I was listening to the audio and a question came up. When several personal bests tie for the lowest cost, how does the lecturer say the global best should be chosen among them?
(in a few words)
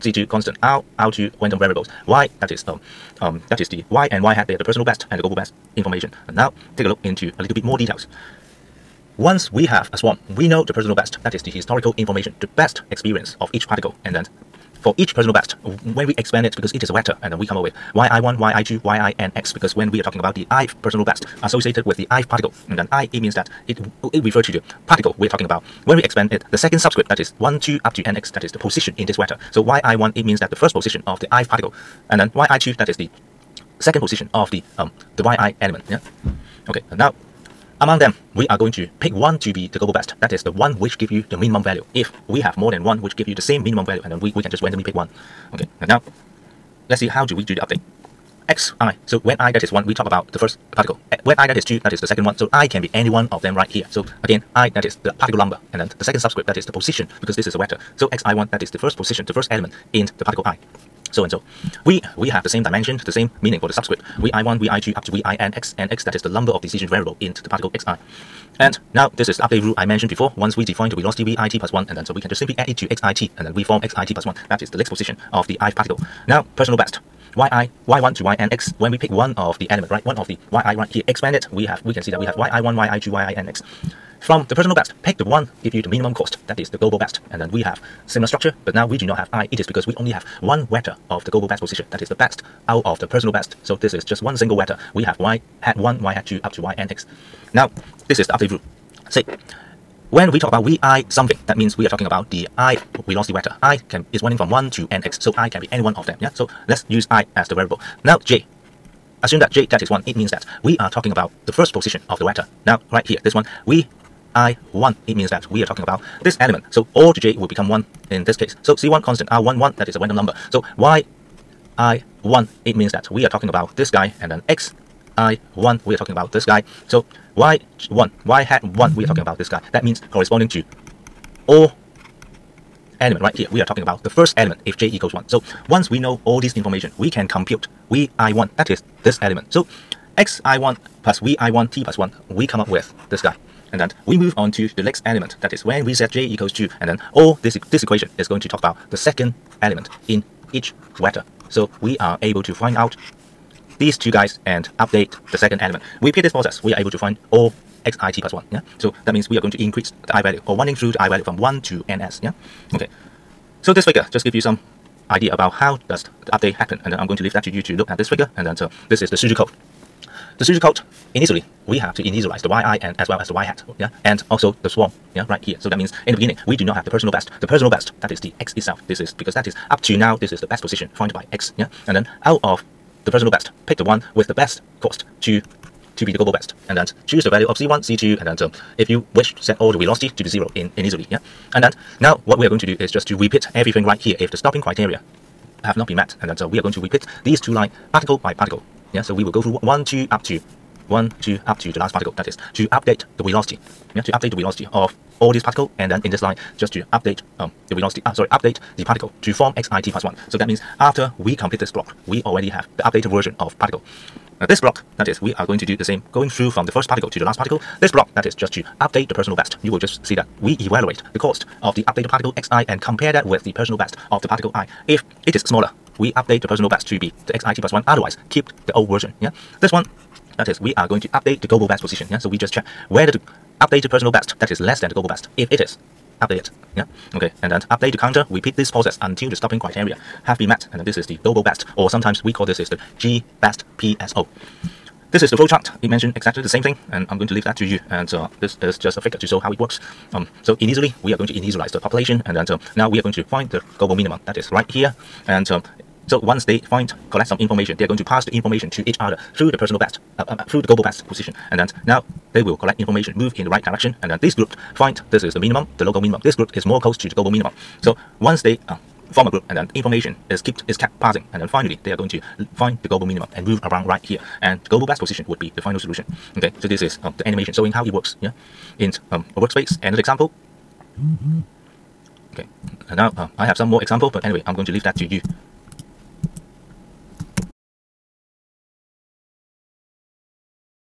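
randomly pick one.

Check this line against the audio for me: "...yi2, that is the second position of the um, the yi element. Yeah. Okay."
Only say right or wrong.
right.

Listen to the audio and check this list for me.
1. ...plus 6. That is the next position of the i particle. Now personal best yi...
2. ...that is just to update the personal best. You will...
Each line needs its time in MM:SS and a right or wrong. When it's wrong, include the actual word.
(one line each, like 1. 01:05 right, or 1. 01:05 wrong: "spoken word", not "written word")
1. 01:14 wrong: "1", not "6"
2. 03:38 right.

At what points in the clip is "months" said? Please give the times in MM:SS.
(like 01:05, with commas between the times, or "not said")
not said.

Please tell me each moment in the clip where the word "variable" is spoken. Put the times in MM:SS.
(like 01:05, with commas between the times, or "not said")
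00:01, 01:06, 01:47.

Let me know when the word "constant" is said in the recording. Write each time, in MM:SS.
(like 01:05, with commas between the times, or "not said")
00:00, 01:59.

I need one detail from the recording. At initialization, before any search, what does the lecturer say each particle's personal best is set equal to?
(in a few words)
the x itself.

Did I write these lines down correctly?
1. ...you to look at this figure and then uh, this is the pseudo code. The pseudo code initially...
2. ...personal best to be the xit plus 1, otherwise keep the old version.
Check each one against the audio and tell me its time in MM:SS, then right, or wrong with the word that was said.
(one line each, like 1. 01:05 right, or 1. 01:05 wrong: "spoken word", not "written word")
1. 02:47 right
2. 03:46 right.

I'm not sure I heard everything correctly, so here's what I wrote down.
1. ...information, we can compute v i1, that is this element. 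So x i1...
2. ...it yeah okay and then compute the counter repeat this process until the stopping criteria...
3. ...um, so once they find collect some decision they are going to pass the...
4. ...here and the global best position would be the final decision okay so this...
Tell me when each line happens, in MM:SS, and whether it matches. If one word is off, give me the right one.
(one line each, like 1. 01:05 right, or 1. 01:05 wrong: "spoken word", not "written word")
1. 02:16 right
2. 03:56 wrong: "update", not "compute"
3. 04:15 wrong: "information", not "decision"
4. 04:34 wrong: "solution", not "decision".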